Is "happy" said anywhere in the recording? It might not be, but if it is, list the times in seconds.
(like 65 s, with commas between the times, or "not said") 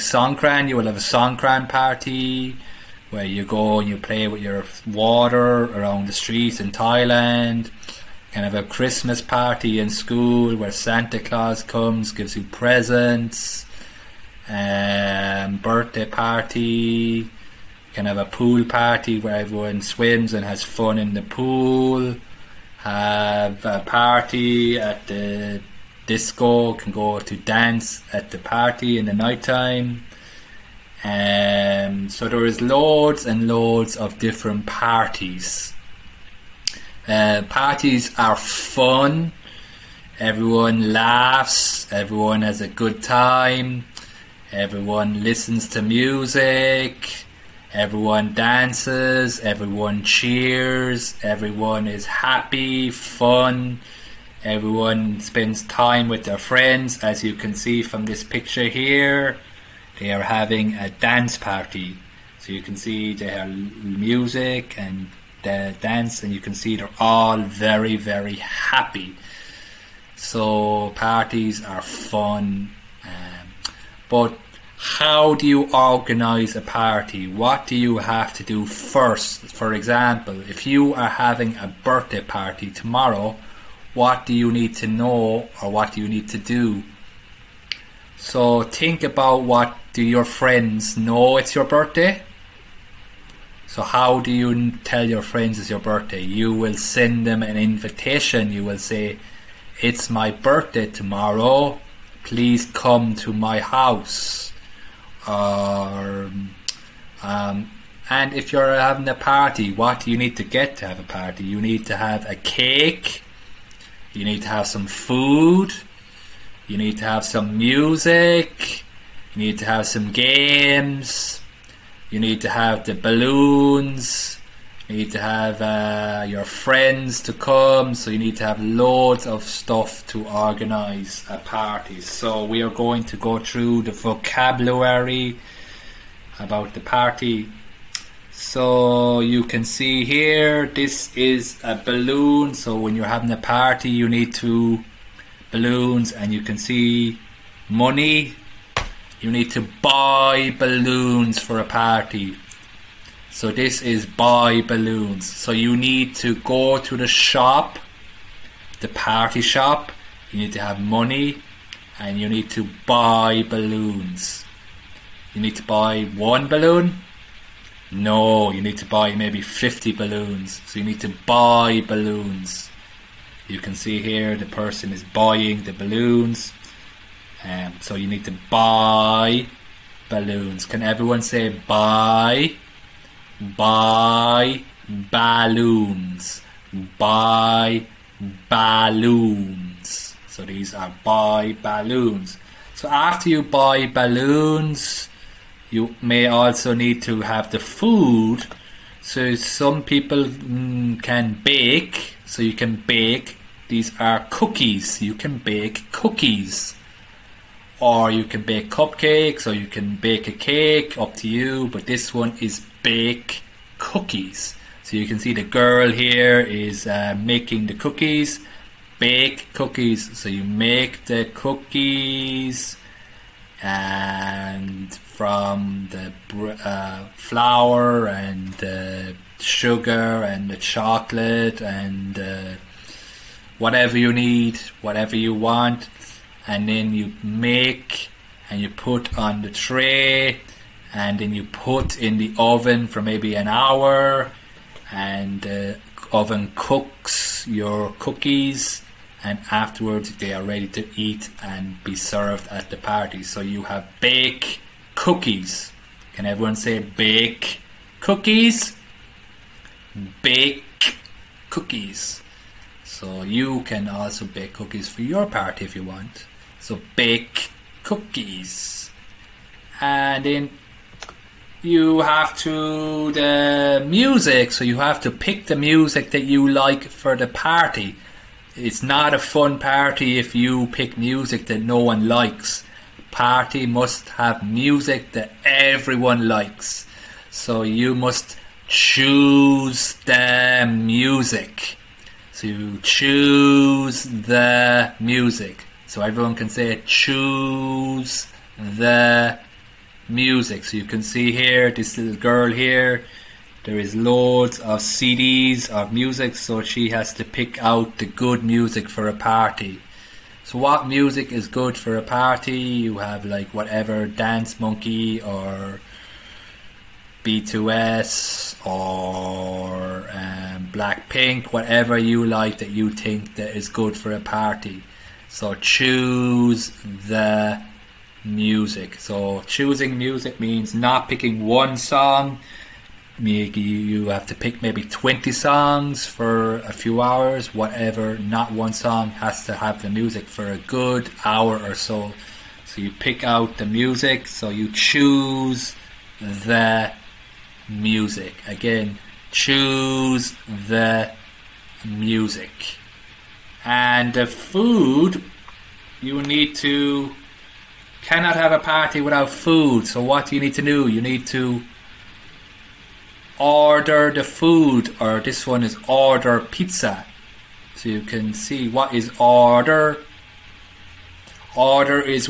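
52 s, 68 s.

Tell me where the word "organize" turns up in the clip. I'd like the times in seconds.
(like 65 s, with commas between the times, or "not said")
75 s, 130 s.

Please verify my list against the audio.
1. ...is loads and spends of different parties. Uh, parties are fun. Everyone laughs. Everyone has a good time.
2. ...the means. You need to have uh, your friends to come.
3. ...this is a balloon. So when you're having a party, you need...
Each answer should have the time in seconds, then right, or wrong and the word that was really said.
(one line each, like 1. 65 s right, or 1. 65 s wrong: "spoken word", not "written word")
1. 32 s wrong: "loads", not "spends"
2. 122 s wrong: "balloons", not "means"
3. 140 s right.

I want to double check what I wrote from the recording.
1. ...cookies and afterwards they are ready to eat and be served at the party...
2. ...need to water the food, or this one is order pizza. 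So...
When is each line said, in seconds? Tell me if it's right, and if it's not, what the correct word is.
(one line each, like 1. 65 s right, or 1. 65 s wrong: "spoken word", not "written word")
1. 247 s right
2. 361 s wrong: "order", not "water".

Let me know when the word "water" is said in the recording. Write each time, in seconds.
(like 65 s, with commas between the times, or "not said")
4 s.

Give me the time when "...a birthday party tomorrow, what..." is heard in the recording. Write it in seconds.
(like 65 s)
81 s.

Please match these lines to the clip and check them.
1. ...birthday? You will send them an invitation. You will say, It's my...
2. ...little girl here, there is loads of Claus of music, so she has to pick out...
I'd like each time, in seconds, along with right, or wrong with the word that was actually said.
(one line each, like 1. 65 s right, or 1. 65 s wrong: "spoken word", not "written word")
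1. 95 s right
2. 301 s wrong: "CDs", not "Claus".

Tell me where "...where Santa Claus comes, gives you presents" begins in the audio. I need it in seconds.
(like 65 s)
10 s.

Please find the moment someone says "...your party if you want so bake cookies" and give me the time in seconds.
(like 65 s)
265 s.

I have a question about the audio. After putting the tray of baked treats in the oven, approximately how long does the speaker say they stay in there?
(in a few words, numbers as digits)
an hour.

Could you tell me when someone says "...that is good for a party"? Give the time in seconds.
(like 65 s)
323 s.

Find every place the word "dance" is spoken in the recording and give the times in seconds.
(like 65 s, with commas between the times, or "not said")
27 s, 48 s, 60 s, 65 s, 314 s.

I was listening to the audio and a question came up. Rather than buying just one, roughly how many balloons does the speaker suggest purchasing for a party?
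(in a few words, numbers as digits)
50.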